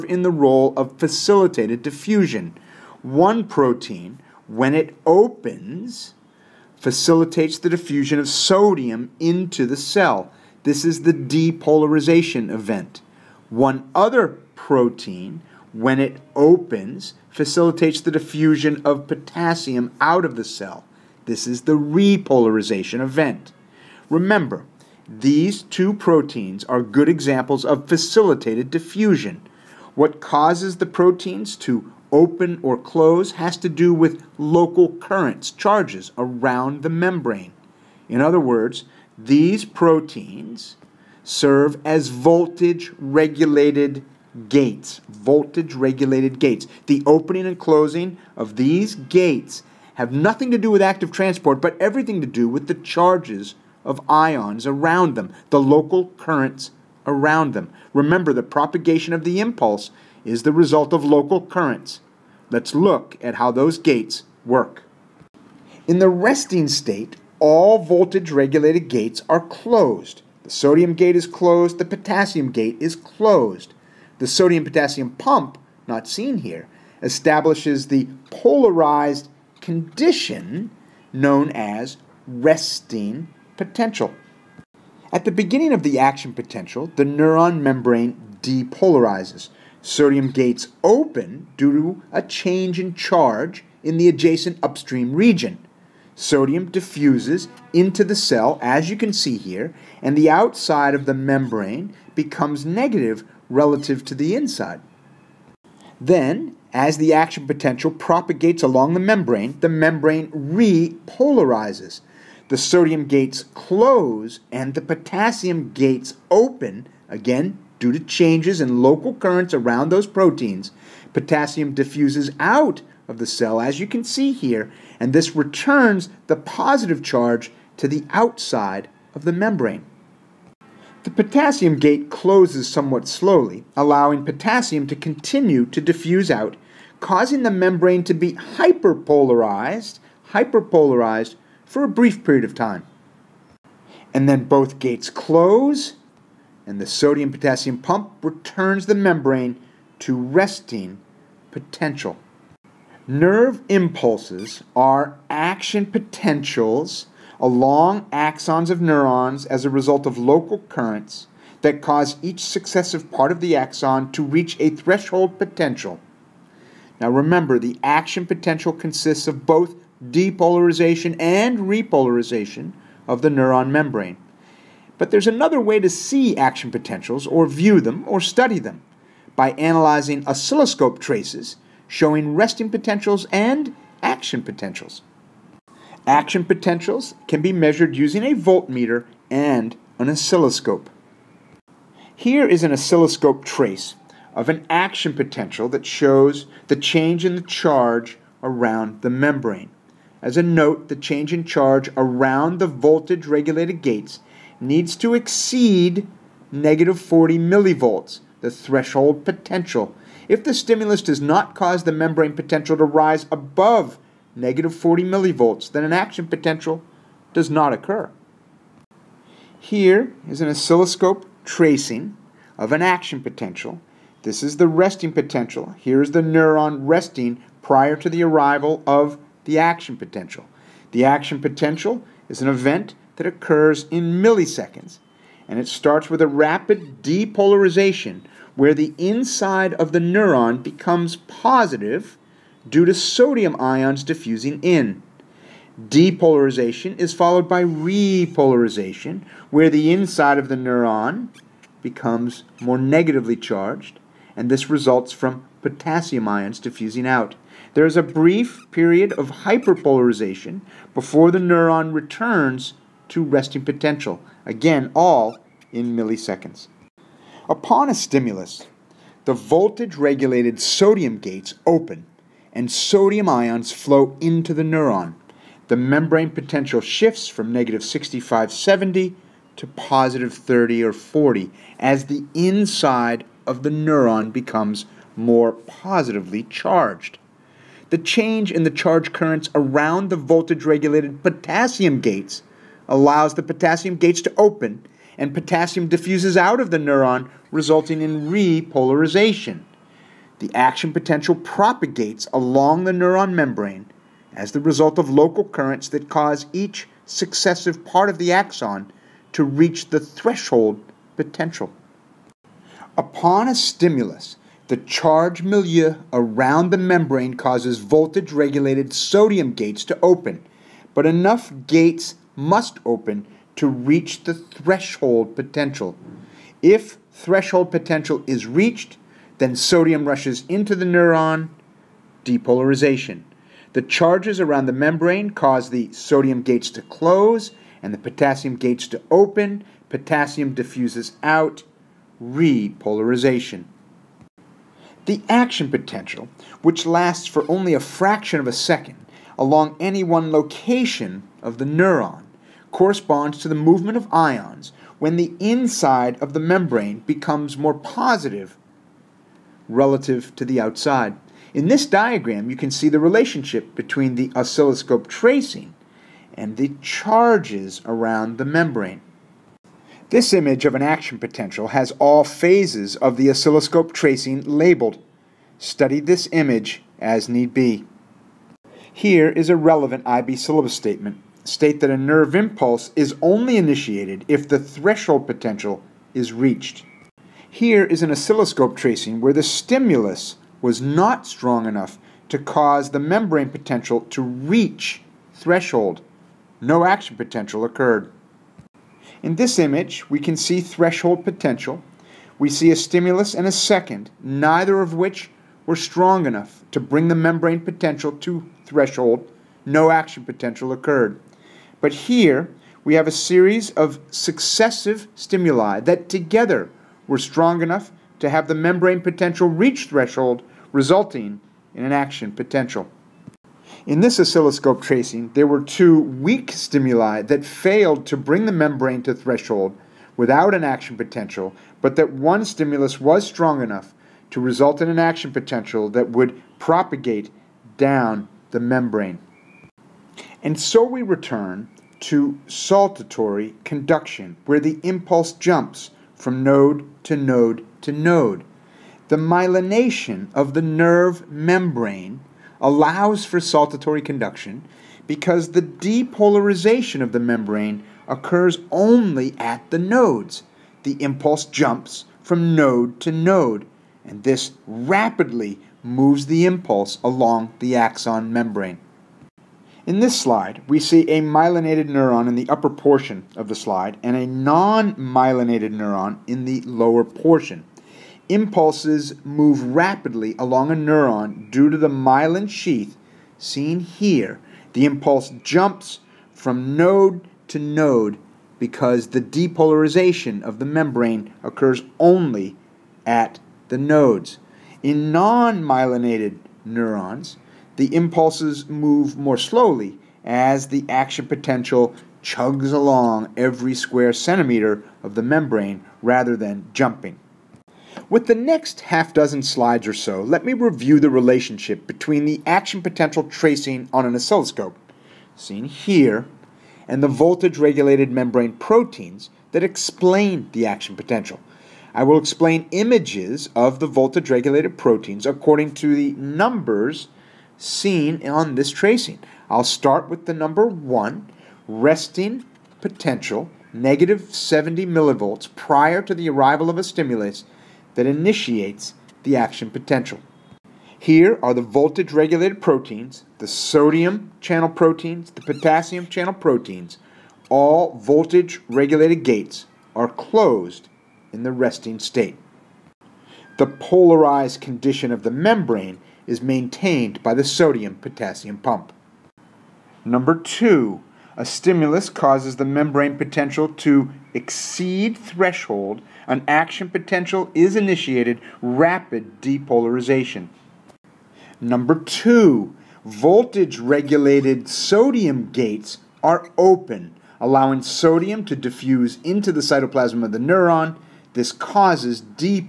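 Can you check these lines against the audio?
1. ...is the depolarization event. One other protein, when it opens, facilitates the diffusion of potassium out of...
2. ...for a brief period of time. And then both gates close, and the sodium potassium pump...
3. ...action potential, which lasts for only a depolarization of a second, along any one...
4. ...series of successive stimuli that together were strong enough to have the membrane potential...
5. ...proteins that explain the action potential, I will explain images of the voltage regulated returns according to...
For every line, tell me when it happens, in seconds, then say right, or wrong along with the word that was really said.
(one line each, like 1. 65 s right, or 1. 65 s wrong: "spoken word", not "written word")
1. 10 s right
2. 141 s right
3. 345 s wrong: "fraction", not "depolarization"
4. 413 s right
5. 518 s wrong: "proteins", not "returns".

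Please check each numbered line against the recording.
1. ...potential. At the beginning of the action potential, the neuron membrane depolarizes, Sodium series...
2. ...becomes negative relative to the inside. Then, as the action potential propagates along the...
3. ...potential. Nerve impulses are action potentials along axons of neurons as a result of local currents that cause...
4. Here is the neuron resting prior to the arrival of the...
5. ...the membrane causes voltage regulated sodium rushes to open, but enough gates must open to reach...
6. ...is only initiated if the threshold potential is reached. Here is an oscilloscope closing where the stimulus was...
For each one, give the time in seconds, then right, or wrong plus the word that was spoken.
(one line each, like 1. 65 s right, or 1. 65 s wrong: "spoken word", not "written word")
1. 83 s wrong: "gates", not "series"
2. 102 s right
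3. 151 s right
4. 225 s right
5. 316 s wrong: "gates", not "rushes"
6. 382 s wrong: "tracing", not "closing".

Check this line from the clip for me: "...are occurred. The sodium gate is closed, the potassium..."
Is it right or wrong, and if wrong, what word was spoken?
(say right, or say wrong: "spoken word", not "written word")
wrong: "closed", not "occurred".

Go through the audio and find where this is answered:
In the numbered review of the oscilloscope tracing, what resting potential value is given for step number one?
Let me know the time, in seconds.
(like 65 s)
533 s.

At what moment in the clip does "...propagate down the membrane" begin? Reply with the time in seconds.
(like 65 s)
436 s.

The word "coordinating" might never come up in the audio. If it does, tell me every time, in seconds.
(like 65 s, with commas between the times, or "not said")
not said.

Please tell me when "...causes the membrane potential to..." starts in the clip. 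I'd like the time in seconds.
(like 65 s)
562 s.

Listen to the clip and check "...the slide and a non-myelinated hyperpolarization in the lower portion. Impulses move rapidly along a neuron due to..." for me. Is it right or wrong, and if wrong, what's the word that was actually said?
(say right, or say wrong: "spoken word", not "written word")
wrong: "neuron", not "hyperpolarization".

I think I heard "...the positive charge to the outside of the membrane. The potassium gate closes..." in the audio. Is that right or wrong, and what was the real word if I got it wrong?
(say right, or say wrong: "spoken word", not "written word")
right.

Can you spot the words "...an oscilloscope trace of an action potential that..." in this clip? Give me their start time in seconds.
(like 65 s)
192 s.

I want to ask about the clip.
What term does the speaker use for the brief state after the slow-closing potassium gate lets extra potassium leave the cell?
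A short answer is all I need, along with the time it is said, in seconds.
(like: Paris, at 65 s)
hyperpolarized, at 137 s.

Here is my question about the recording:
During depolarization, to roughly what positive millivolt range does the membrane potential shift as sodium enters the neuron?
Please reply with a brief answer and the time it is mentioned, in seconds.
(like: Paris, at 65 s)
30 or 40, at 279 s.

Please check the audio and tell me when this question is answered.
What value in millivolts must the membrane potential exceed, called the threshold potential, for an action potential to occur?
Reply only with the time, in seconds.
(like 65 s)
206 s.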